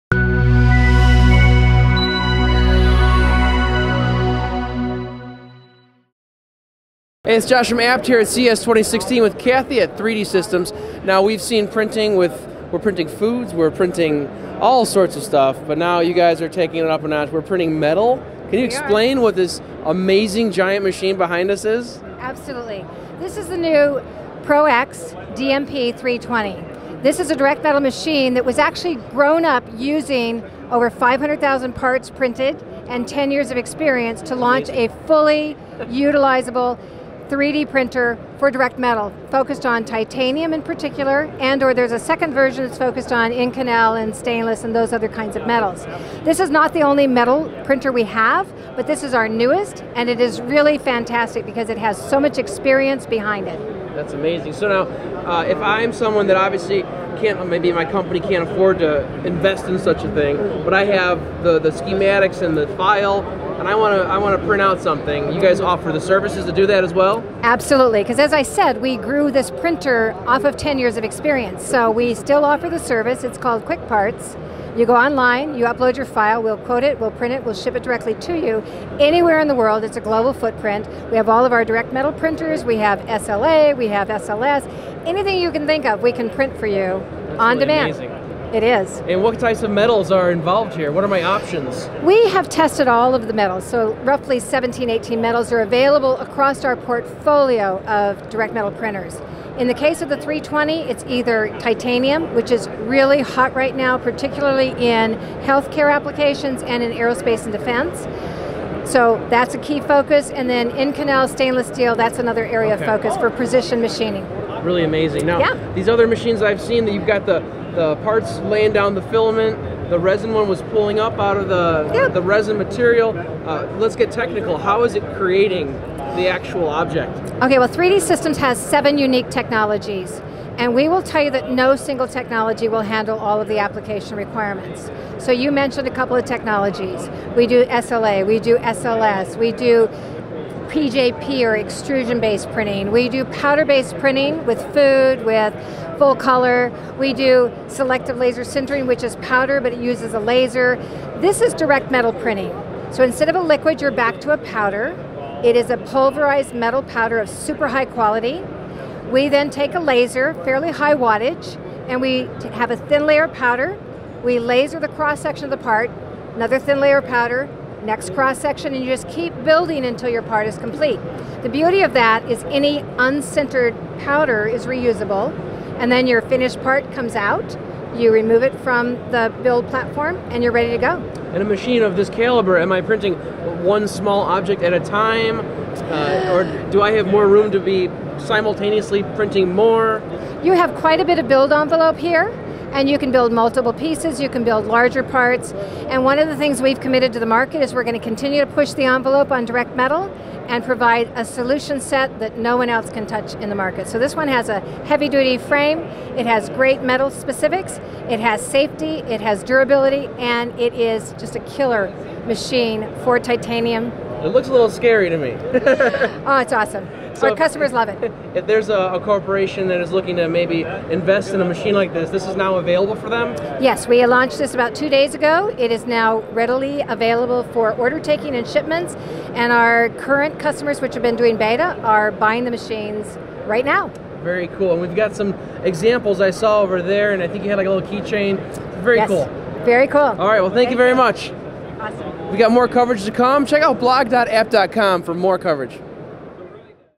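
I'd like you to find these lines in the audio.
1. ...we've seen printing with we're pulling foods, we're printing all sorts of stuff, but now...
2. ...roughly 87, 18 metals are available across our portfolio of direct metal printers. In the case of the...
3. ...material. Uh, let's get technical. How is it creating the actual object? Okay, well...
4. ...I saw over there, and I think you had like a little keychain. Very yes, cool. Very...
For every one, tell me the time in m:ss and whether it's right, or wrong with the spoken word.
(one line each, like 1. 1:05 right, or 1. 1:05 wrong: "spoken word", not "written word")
1. 0:11 wrong: "printing", not "pulling"
2. 1:34 wrong: "17", not "87"
3. 2:02 right
4. 3:56 right.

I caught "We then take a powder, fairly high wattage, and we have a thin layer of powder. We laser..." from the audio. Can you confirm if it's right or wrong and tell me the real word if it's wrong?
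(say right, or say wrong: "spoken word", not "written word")
wrong: "laser", not "powder".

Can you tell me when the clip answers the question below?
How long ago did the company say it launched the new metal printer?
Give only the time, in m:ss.
3:44.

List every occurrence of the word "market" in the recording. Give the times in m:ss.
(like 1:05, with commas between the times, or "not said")
3:17, 3:23.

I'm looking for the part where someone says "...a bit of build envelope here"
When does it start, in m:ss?
3:10.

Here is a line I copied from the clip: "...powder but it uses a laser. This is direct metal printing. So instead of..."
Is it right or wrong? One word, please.
right.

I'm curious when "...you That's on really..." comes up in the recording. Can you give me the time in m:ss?
1:26.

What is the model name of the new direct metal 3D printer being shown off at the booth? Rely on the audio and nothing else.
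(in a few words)
ProX DMP 320.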